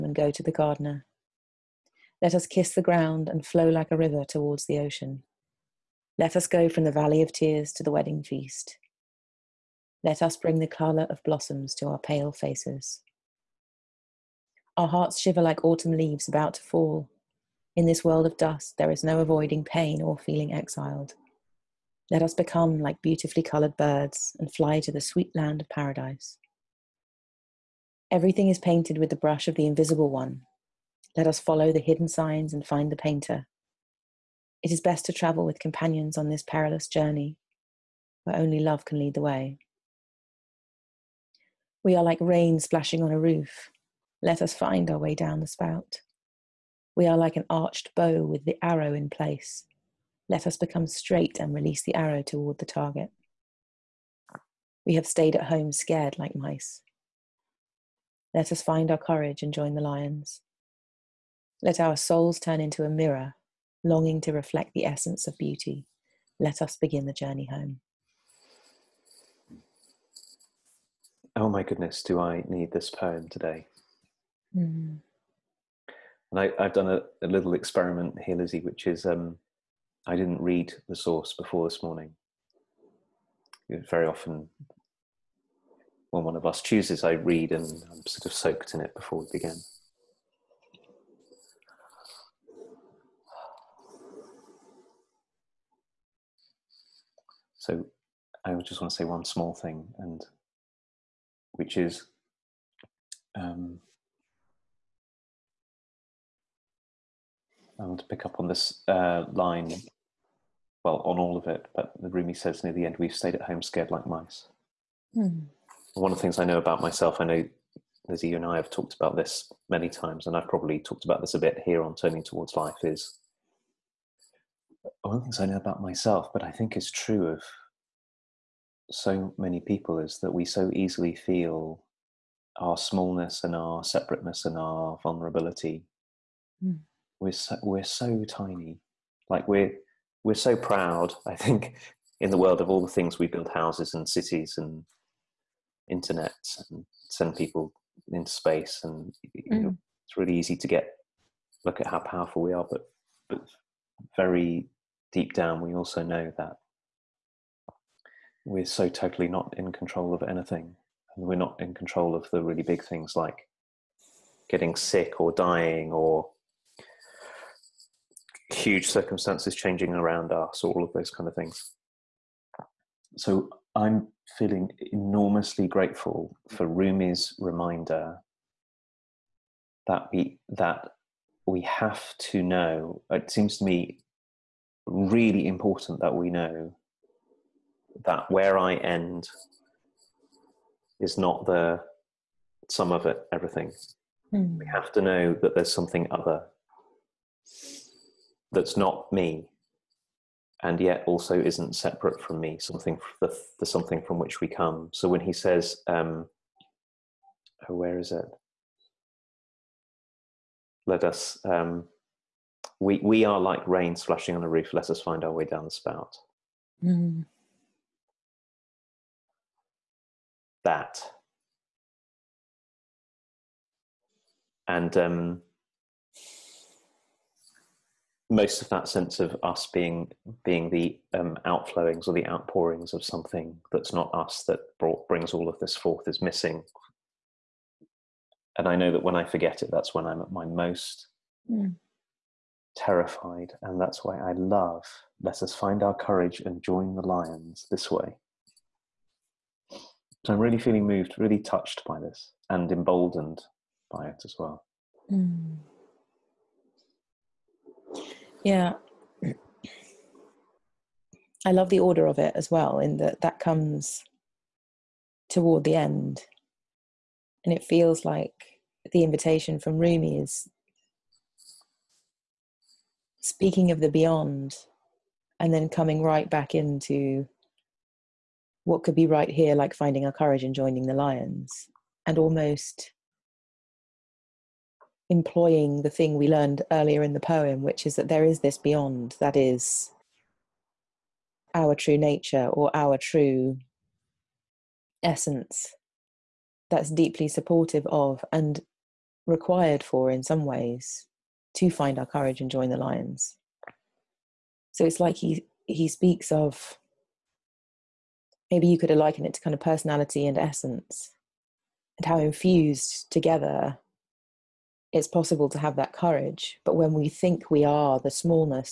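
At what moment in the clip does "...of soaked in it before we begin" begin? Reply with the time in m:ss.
1:28.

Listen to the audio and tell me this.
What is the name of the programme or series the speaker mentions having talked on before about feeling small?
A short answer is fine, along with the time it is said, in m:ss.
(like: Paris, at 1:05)
Turning Towards Life, at 2:01.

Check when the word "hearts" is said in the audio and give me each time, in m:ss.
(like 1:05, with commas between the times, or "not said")
0:14.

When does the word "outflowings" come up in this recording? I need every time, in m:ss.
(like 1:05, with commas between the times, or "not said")
3:51.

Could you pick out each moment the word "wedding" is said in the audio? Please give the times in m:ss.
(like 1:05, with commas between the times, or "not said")
0:07.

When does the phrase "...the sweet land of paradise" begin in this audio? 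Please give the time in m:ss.
0:24.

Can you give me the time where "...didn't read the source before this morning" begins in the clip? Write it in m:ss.
1:20.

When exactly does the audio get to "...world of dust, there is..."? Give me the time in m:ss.
0:18.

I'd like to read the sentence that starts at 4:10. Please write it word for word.
So I'm really feeling moved, really touched by this and emboldened by it as well.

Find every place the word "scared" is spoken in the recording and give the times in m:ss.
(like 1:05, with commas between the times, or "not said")
0:55, 1:53.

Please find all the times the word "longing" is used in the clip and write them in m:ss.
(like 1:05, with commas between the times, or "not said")
1:03.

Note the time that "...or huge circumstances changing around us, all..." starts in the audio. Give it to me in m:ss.
2:45.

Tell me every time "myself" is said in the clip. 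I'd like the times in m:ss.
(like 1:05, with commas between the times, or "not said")
1:56, 2:05.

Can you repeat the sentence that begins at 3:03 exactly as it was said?
It seems to me really important that we know that where I end is not the sum of it, everything.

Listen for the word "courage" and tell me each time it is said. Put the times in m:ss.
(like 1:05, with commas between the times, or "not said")
0:58, 4:05, 4:40, 5:02, 5:15.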